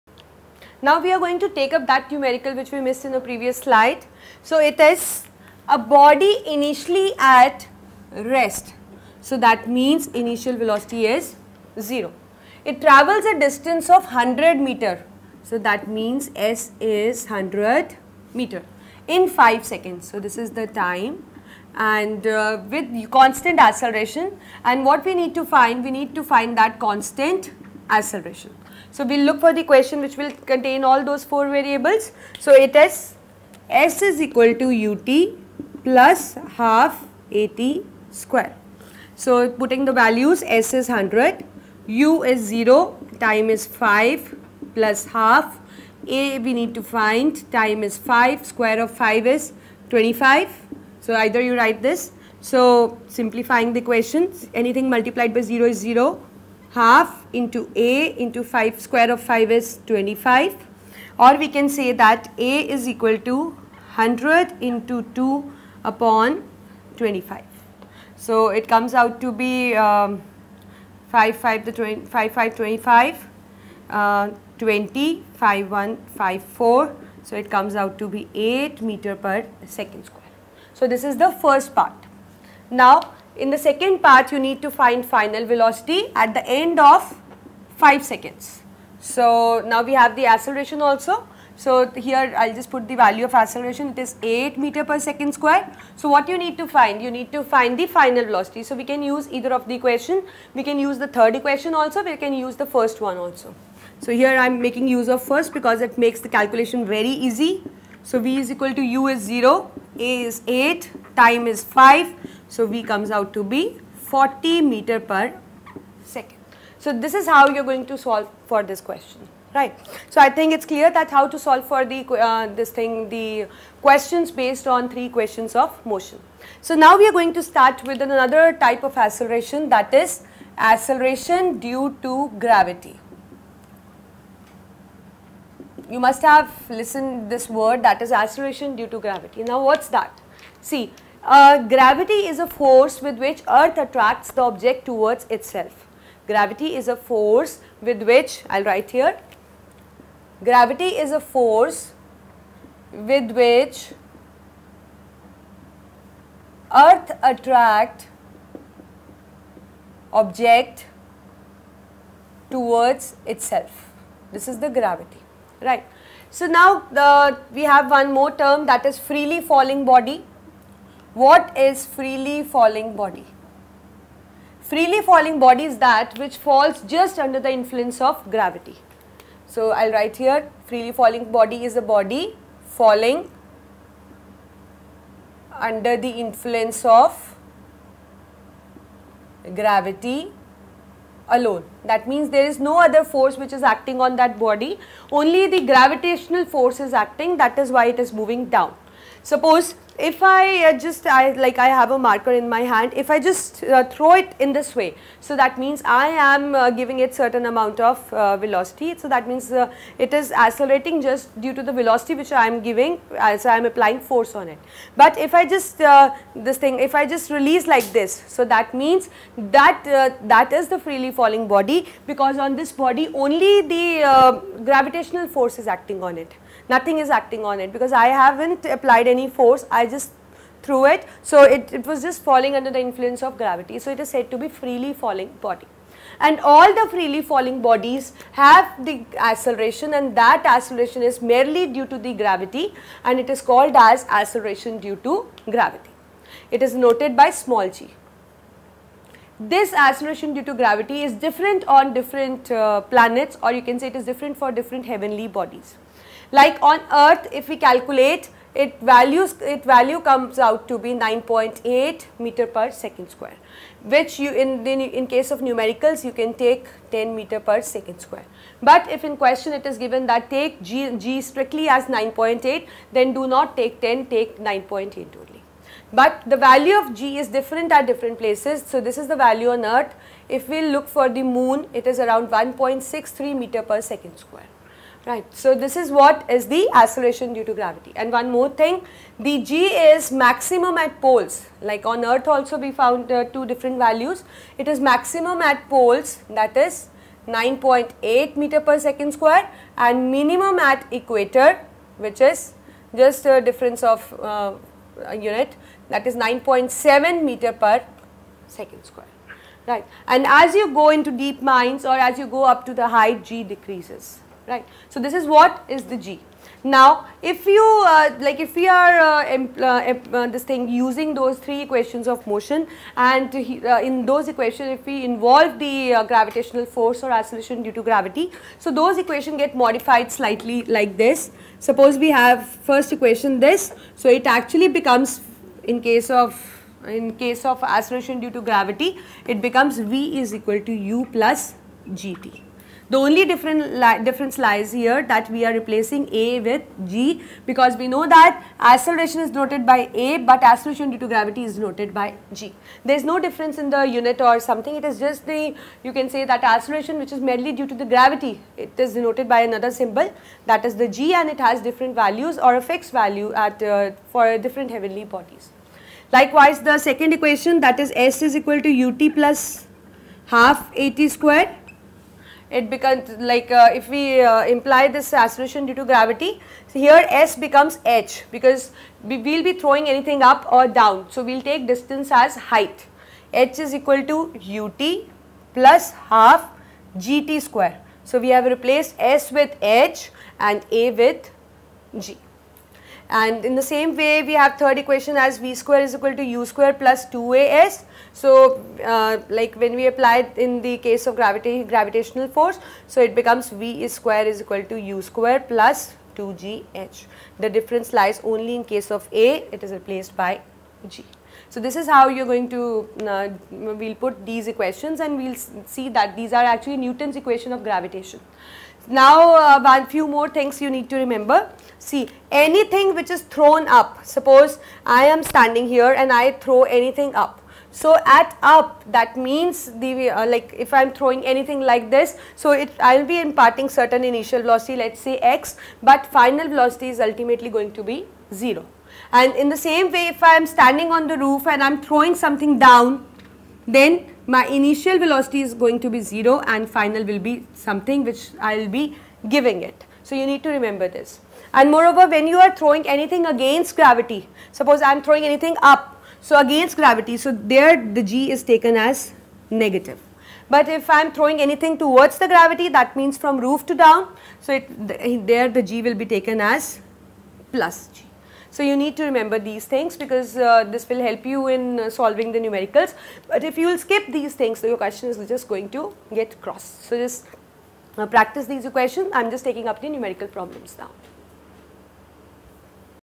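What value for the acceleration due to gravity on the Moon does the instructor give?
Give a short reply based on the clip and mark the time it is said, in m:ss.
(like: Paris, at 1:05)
1.63 m/s², at 4:42.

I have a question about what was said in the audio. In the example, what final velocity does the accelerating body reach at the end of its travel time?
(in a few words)
40 meters per second.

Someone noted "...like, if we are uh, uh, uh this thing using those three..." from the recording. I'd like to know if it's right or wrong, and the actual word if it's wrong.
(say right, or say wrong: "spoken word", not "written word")
right.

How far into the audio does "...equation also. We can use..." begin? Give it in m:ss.
1:41.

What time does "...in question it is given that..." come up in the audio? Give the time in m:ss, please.
4:29.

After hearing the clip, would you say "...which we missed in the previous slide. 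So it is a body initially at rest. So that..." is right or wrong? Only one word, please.
right.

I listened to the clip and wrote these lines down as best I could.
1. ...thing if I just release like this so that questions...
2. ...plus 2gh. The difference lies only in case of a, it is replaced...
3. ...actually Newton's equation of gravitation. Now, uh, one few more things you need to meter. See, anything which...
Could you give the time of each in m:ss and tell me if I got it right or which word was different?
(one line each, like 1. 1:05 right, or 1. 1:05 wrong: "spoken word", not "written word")
1. 3:36 wrong: "means", not "questions"
2. 6:45 right
3. 6:56 wrong: "remember", not "meter".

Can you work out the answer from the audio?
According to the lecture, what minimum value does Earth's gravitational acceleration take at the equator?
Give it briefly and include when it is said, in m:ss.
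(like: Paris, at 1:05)
9.7 m/s², at 5:06.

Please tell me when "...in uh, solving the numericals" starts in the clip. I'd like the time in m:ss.
7:51.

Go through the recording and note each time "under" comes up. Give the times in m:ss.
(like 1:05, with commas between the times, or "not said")
2:57, 3:05, 3:52.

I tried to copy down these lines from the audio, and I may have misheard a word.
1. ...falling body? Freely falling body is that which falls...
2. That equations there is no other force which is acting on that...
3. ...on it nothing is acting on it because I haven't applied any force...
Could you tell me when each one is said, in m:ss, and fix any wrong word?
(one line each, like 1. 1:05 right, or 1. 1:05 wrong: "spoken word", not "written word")
1. 2:52 right
2. 3:11 wrong: "means", not "equations"
3. 3:46 right.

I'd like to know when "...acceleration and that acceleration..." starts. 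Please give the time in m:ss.
3:59.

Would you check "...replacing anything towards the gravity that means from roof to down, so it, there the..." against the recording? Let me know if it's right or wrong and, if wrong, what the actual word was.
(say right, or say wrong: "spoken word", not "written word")
wrong: "throwing", not "replacing".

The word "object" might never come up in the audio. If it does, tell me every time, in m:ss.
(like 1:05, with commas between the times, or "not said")
2:24, 2:40.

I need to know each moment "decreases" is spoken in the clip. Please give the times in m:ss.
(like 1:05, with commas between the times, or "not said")
5:13.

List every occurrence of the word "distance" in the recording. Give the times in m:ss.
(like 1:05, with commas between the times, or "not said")
0:13, 6:21.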